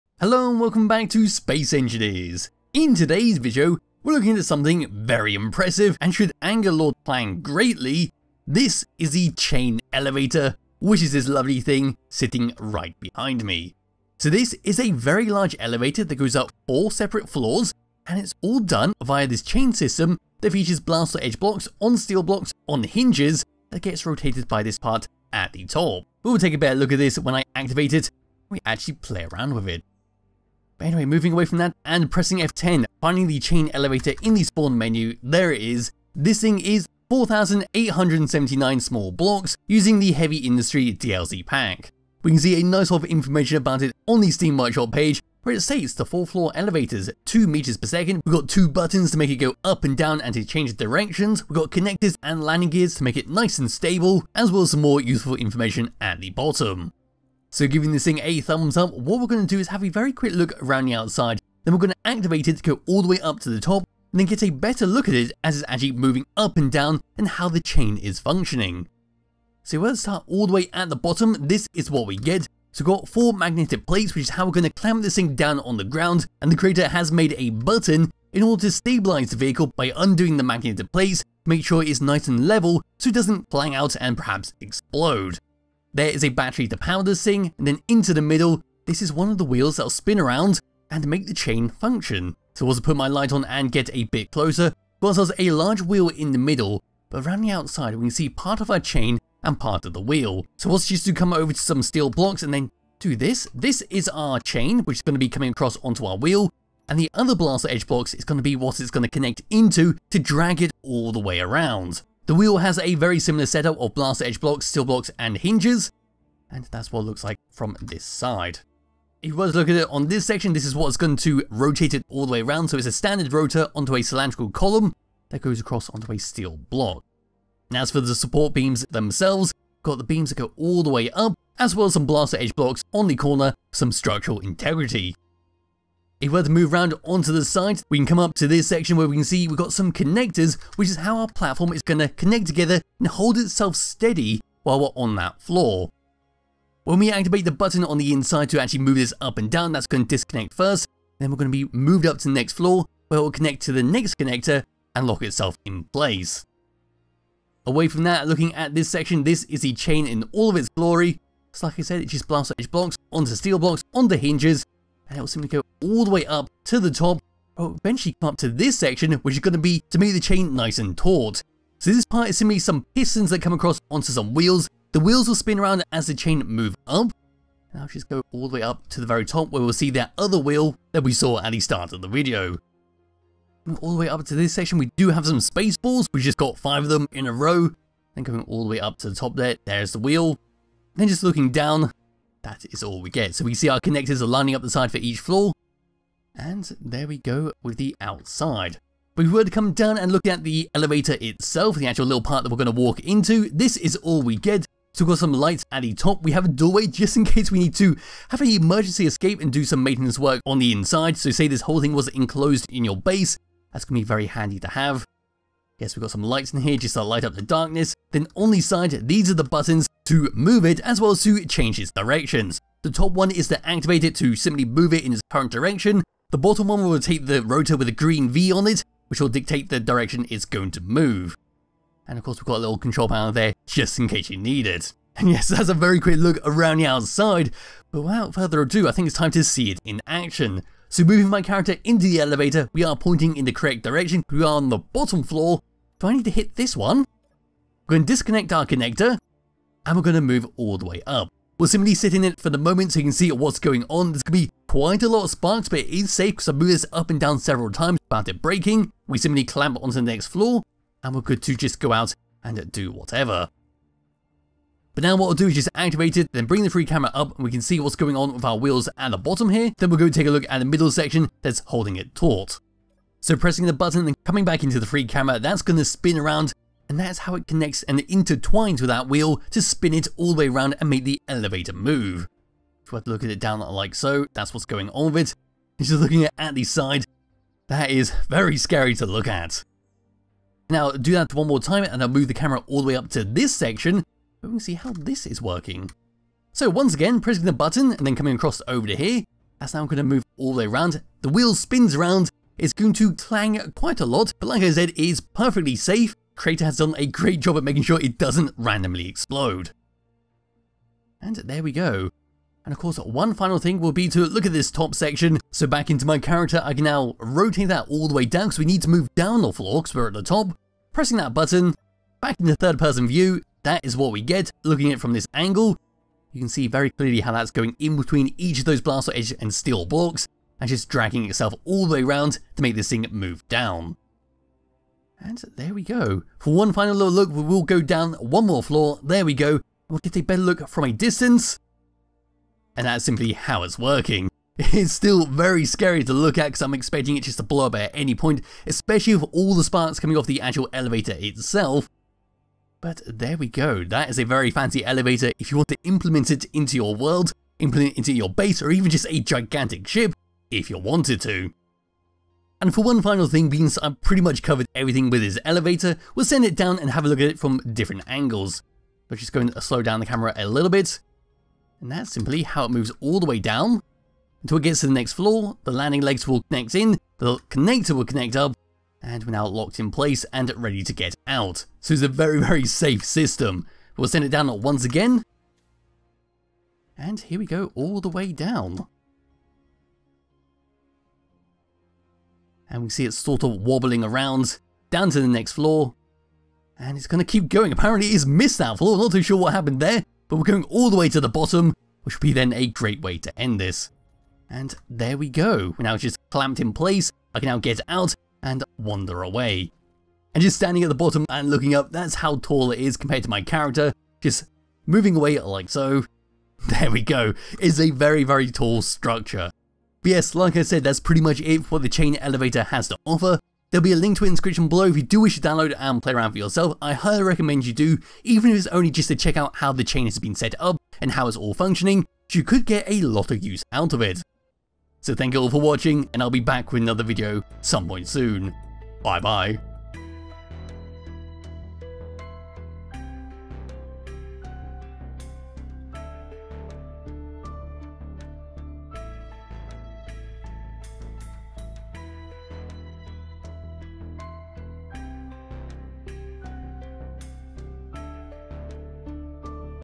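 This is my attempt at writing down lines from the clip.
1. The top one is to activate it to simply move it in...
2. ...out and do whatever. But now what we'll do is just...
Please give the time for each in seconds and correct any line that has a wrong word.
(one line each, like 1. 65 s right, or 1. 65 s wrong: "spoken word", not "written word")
1. 222 s right
2. 261 s right.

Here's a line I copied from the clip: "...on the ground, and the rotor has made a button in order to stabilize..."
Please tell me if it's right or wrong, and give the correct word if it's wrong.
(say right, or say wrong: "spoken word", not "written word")
wrong: "creator", not "rotor".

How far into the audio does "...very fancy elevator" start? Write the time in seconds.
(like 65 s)
354 s.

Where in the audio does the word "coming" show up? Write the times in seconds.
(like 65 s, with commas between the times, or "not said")
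105 s, 274 s, 298 s, 349 s.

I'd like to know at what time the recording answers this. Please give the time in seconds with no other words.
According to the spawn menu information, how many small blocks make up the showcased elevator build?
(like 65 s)
37 s.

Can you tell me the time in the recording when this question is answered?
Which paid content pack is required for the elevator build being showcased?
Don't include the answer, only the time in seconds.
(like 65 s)
40 s.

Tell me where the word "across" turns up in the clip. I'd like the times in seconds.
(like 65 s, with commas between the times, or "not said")
105 s, 125 s, 173 s, 298 s.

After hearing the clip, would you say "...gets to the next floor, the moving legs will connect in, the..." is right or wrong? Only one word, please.
wrong.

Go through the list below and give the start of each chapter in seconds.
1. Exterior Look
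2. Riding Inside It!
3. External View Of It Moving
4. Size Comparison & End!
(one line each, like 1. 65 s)
1. 70 s
2. 243 s
3. 263 s
4. 411 s.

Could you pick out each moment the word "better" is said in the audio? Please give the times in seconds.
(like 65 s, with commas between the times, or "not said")
26 s, 64 s, 340 s.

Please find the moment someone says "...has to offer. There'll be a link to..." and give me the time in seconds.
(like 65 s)
422 s.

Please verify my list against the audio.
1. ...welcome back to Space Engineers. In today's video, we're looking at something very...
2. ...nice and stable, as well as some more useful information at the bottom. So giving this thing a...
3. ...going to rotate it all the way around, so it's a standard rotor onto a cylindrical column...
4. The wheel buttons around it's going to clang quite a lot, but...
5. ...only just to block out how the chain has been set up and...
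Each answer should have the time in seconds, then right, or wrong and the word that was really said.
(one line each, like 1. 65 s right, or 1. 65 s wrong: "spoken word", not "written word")
1. 0 s right
2. 53 s right
3. 120 s right
4. 301 s wrong: "spins", not "buttons"
5. 428 s wrong: "check", not "block".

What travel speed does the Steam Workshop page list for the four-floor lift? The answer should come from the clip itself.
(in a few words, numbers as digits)
2 meters per second.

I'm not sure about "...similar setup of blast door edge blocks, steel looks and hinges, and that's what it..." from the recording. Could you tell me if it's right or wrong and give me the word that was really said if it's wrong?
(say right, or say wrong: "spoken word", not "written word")
wrong: "blocks", not "looks".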